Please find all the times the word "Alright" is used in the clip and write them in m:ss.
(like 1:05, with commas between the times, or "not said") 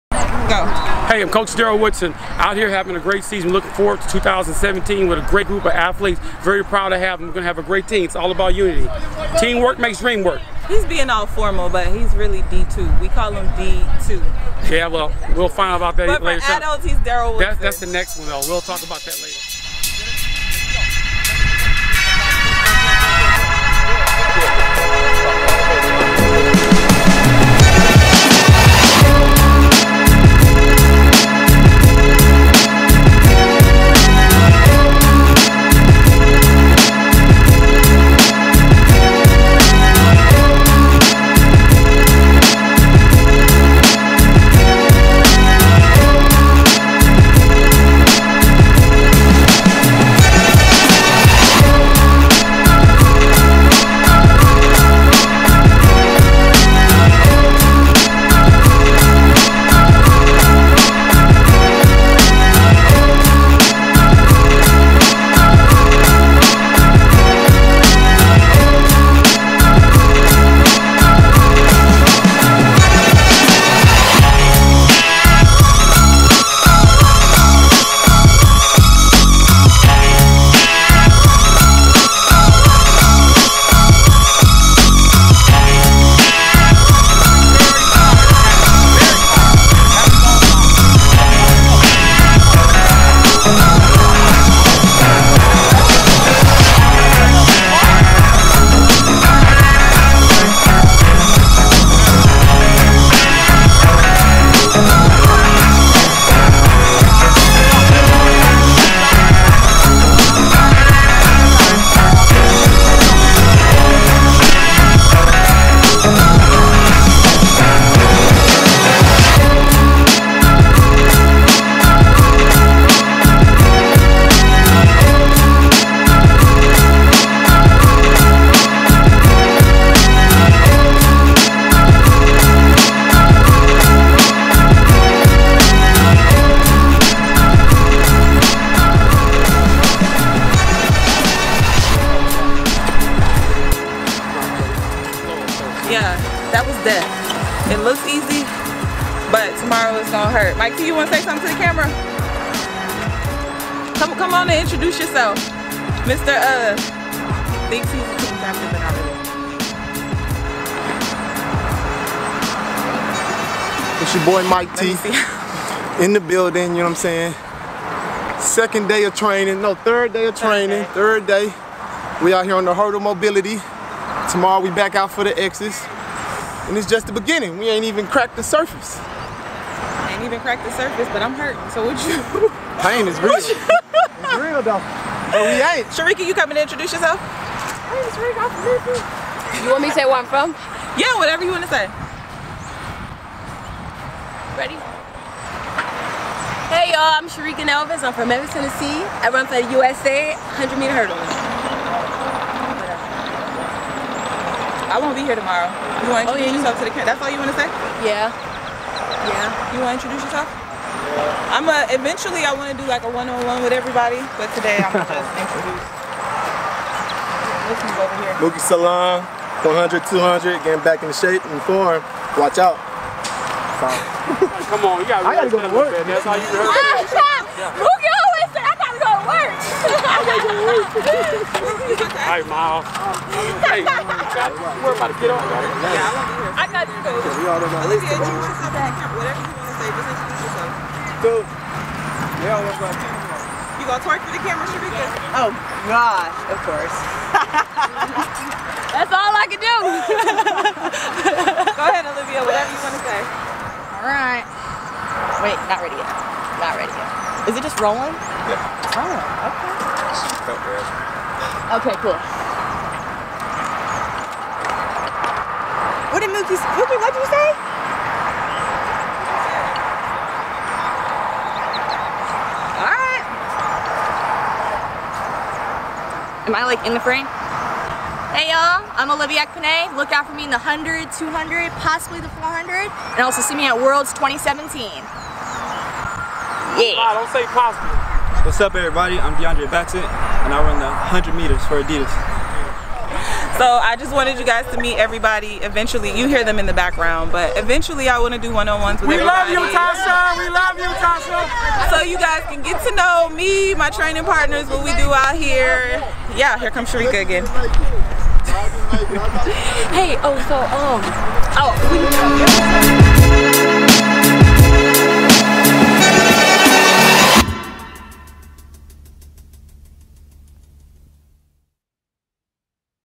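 3:50, 4:13, 4:32.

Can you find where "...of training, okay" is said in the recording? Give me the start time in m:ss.
2:50.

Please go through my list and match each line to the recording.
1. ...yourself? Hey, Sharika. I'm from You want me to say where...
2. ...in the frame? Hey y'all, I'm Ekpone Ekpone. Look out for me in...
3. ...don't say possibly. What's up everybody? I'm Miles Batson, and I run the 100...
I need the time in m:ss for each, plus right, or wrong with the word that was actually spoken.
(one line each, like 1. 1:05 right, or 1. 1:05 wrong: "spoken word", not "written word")
1. 3:06 right
2. 4:36 wrong: "Olivia", not "Ekpone"
3. 4:47 wrong: "DeAndre", not "Miles".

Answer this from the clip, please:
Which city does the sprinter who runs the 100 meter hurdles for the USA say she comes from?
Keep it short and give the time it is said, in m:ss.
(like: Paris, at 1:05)
Memphis, Tennessee, at 3:18.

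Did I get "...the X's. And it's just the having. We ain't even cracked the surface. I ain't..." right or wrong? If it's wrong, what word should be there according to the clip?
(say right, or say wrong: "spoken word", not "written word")
wrong: "beginning", not "having".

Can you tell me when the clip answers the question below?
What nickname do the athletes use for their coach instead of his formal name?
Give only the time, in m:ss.
0:13.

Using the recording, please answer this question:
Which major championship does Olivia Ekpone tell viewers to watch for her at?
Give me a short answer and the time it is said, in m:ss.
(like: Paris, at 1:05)
Worlds 2017, at 4:43.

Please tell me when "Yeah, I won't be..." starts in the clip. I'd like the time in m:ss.
3:55.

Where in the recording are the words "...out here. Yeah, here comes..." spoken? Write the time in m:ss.
5:05.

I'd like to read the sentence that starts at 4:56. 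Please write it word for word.
You hear them in the background, but eventually I want to do one-on-ones with we everybody.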